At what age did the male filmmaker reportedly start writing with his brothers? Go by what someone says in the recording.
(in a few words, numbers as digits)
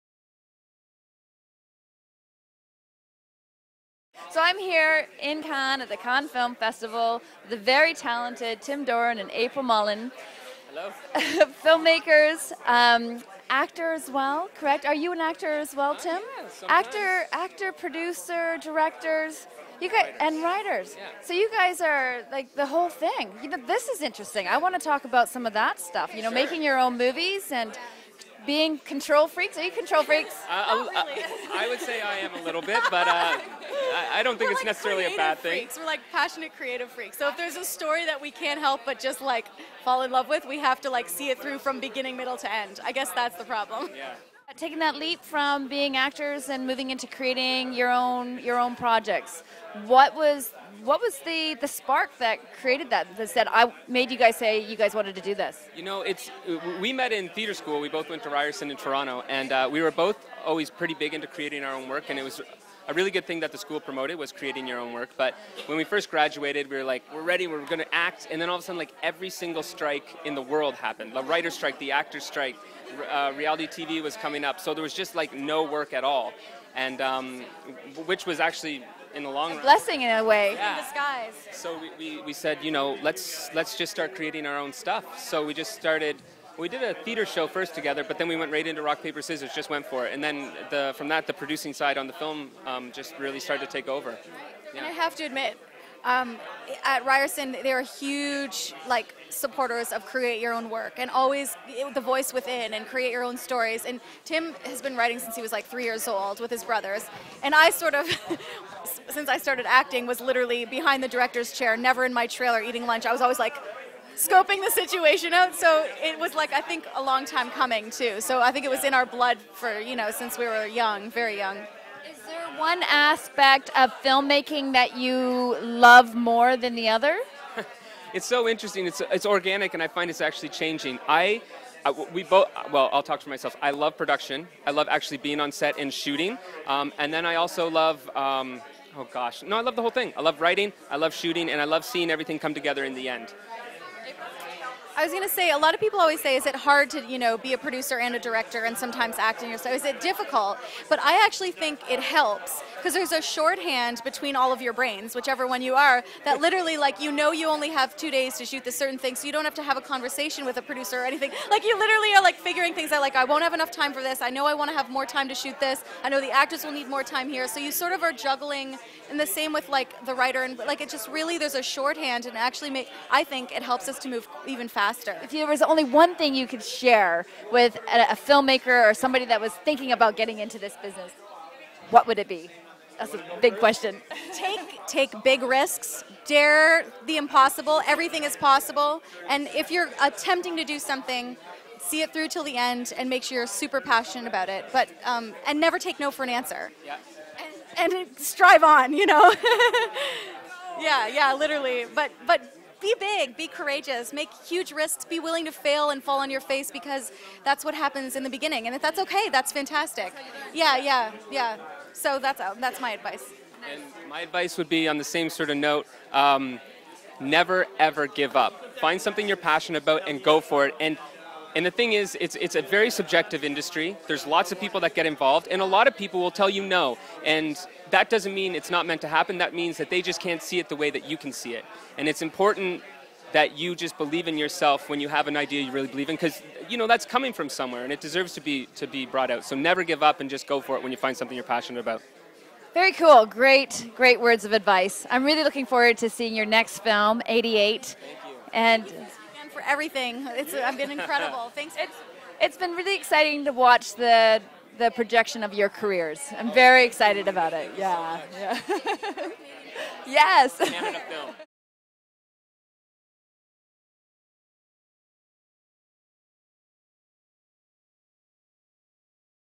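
3.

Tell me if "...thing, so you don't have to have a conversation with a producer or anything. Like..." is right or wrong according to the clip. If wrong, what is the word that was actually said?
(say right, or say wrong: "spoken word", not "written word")
right.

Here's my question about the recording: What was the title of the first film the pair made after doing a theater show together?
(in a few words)
Rock Paper Scissors.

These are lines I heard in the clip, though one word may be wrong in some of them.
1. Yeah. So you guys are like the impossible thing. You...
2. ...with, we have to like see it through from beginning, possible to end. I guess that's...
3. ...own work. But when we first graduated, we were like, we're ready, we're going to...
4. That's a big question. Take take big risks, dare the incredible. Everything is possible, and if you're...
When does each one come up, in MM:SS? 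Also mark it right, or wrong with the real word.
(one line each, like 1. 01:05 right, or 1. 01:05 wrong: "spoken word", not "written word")
1. 00:20 wrong: "whole", not "impossible"
2. 00:40 wrong: "middle", not "possible"
3. 01:04 right
4. 03:02 wrong: "impossible", not "incredible".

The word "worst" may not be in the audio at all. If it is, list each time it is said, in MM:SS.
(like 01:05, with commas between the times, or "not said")
not said.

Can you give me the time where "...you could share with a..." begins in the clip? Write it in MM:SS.
02:56.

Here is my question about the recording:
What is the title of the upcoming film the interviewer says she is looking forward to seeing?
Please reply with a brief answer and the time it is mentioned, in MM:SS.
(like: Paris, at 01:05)
88, at 04:07.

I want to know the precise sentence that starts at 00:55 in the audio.
You know, it's we met in theater school.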